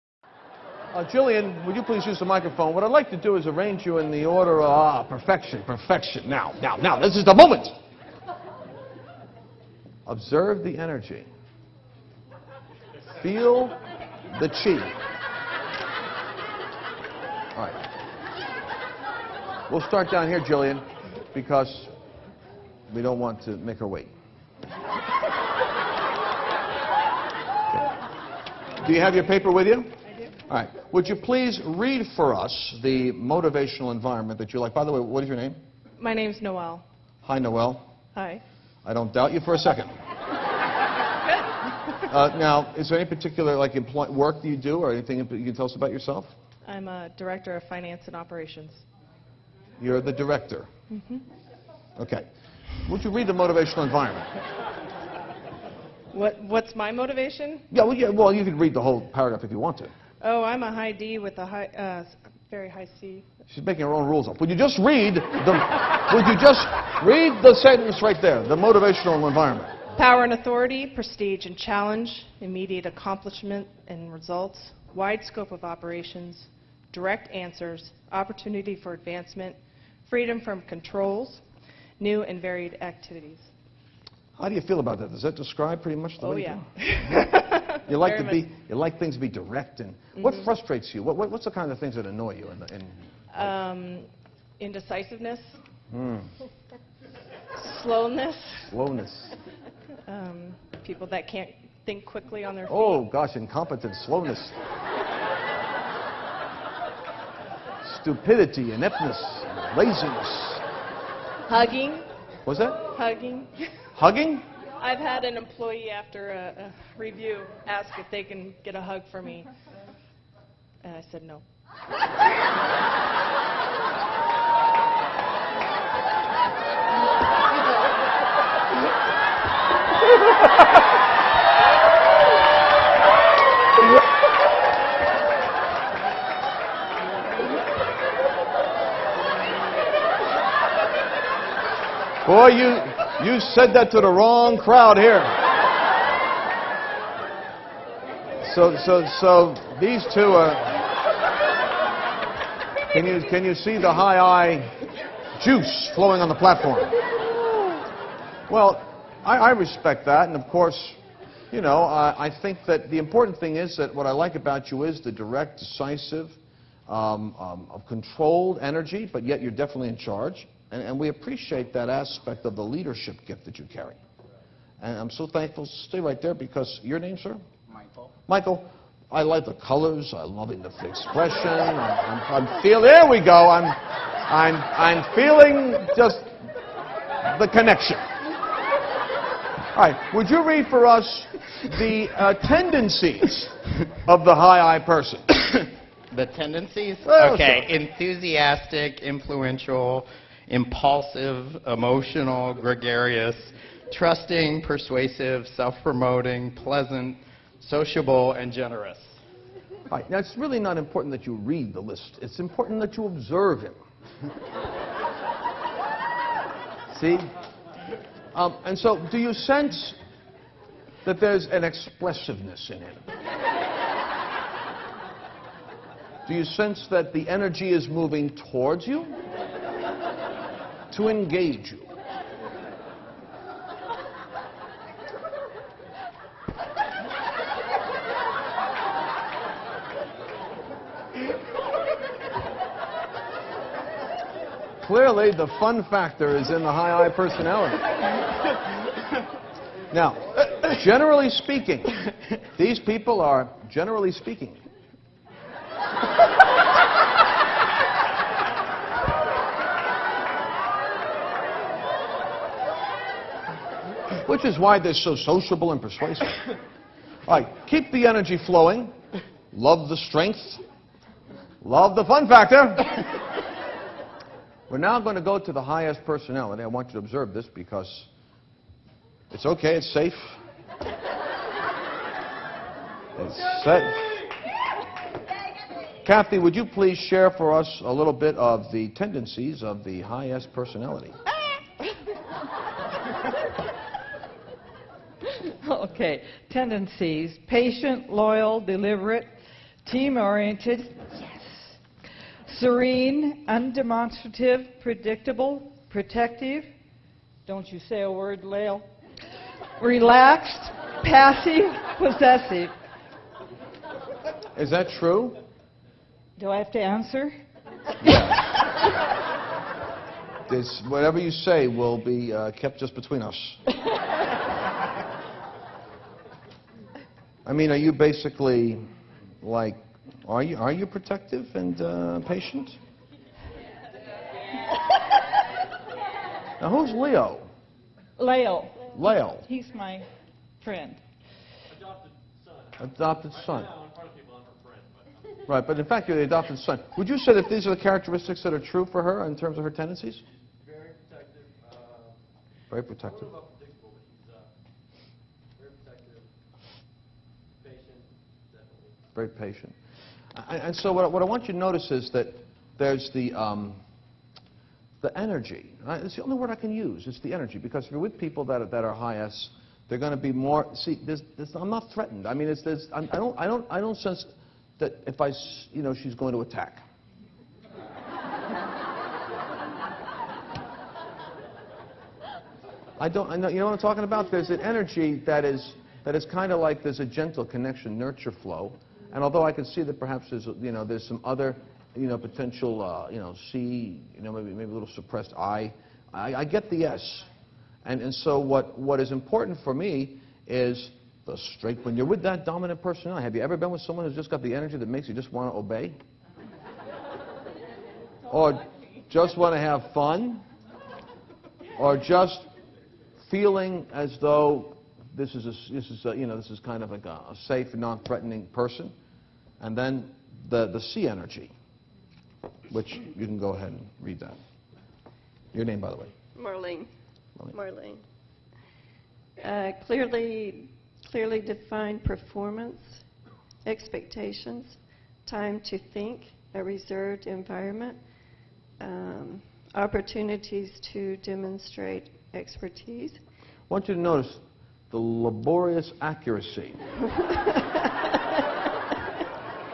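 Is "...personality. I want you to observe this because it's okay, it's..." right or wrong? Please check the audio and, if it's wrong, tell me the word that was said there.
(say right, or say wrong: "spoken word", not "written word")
right.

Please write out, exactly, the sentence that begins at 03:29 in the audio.
All right, now it's really not important that you read the list.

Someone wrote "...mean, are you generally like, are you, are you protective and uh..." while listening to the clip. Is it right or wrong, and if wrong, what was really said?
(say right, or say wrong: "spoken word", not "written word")
wrong: "basically", not "generally".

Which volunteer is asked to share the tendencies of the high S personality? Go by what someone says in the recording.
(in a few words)
Kathy.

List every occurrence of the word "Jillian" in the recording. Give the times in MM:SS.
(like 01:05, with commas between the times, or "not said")
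00:01, 00:20.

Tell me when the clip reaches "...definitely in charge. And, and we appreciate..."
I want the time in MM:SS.
02:49.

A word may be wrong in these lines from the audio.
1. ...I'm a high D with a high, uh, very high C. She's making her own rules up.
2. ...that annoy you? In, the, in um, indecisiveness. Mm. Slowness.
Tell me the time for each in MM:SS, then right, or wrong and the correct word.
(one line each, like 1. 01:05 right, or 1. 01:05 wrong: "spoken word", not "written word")
1. 01:00 right
2. 01:31 right.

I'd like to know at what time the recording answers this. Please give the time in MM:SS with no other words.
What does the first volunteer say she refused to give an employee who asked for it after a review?
01:58.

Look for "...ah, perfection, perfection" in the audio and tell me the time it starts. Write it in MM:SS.
00:04.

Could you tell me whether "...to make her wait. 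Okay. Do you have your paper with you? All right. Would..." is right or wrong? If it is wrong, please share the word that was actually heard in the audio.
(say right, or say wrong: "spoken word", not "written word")
right.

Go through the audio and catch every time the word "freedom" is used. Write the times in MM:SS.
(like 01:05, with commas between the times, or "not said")
01:20.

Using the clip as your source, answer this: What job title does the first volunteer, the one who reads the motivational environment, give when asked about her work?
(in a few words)
Director of finance and operations.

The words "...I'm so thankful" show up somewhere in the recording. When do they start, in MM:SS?
02:54.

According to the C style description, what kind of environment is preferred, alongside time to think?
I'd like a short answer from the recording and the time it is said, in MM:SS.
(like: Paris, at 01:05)
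A reserved environment, at 07:16.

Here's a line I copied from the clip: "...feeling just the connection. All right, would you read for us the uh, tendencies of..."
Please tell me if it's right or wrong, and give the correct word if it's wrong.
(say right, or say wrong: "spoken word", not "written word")
right.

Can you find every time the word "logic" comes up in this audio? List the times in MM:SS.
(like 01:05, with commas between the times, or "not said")
not said.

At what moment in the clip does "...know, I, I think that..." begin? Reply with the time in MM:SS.
02:41.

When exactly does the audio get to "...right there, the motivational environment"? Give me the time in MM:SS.
01:08.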